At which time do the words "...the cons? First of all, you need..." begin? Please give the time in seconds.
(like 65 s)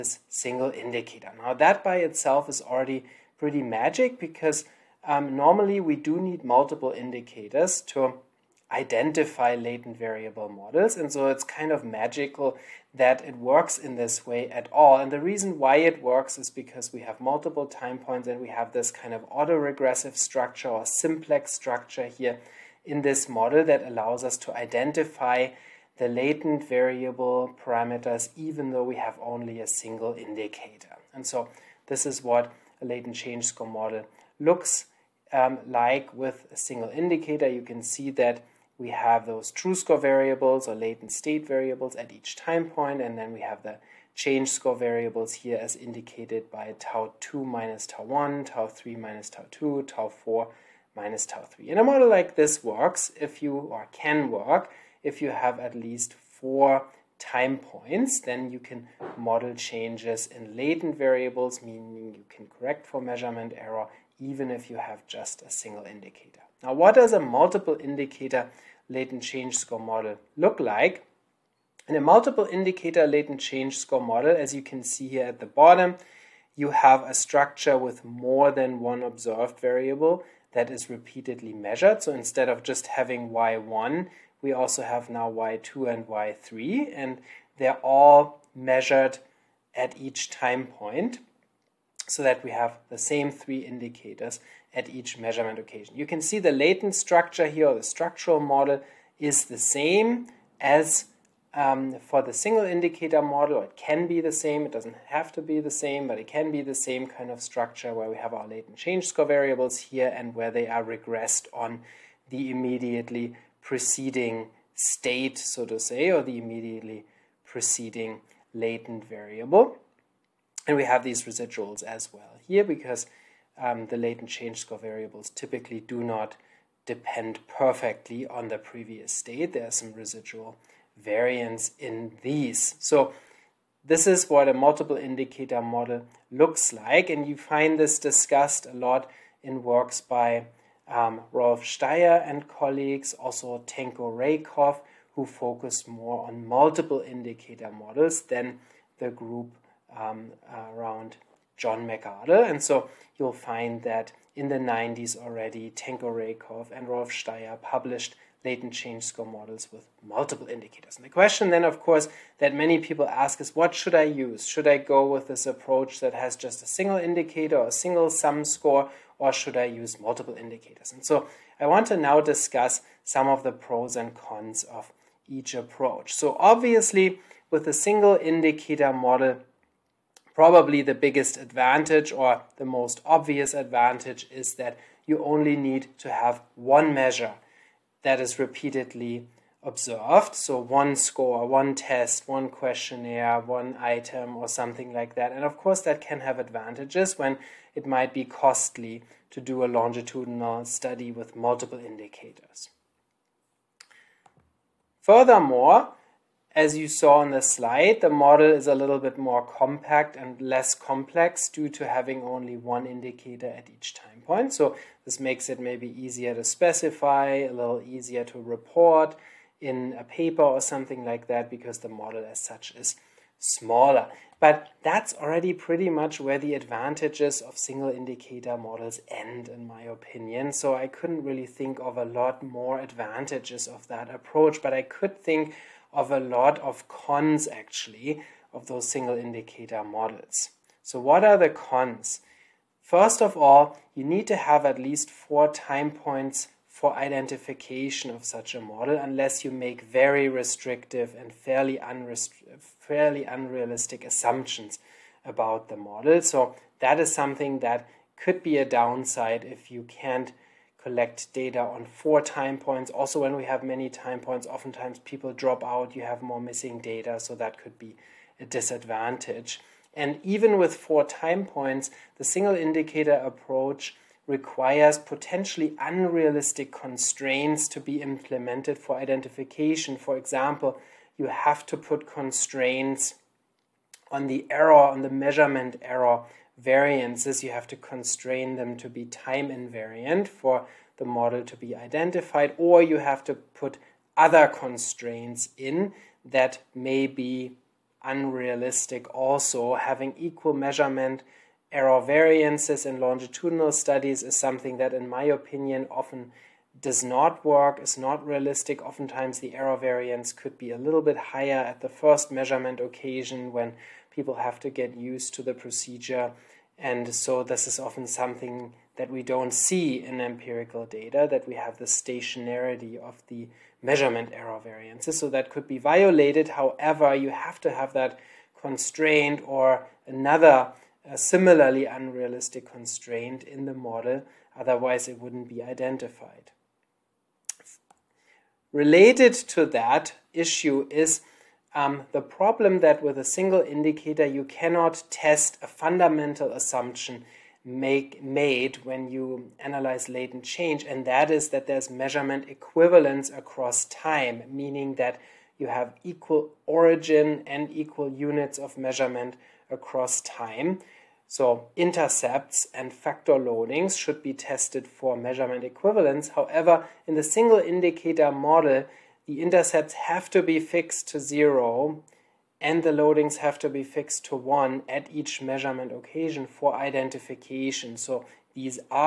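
241 s.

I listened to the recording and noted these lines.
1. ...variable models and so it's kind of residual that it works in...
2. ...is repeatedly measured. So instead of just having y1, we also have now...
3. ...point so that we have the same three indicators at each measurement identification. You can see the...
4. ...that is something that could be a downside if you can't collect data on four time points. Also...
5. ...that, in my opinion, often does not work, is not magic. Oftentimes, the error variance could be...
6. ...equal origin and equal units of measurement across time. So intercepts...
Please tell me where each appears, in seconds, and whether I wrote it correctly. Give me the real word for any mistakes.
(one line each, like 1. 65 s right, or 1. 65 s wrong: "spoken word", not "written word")
1. 9 s wrong: "magical", not "residual"
2. 80 s right
3. 90 s wrong: "occasion", not "identification"
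4. 256 s right
5. 304 s wrong: "realistic", not "magic"
6. 356 s right.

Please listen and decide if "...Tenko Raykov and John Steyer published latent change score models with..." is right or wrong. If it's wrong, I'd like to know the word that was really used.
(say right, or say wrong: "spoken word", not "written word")
wrong: "Rolf", not "John".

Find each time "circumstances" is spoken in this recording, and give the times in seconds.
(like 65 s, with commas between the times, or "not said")
not said.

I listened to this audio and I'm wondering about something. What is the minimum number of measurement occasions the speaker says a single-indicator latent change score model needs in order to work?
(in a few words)
4.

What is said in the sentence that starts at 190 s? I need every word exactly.
So one score, one test, one questionnaire, one item or something like that.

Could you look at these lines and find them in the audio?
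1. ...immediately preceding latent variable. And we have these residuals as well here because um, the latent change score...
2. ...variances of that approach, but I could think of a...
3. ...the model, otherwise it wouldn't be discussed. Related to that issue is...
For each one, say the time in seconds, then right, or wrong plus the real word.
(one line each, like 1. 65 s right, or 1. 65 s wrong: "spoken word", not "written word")
1. 116 s right
2. 232 s wrong: "advantages", not "variances"
3. 333 s wrong: "identified", not "discussed".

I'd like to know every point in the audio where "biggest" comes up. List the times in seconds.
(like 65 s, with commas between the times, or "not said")
180 s.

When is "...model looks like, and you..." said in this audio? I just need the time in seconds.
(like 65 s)
135 s.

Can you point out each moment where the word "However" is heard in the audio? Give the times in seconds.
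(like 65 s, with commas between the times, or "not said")
326 s, 366 s.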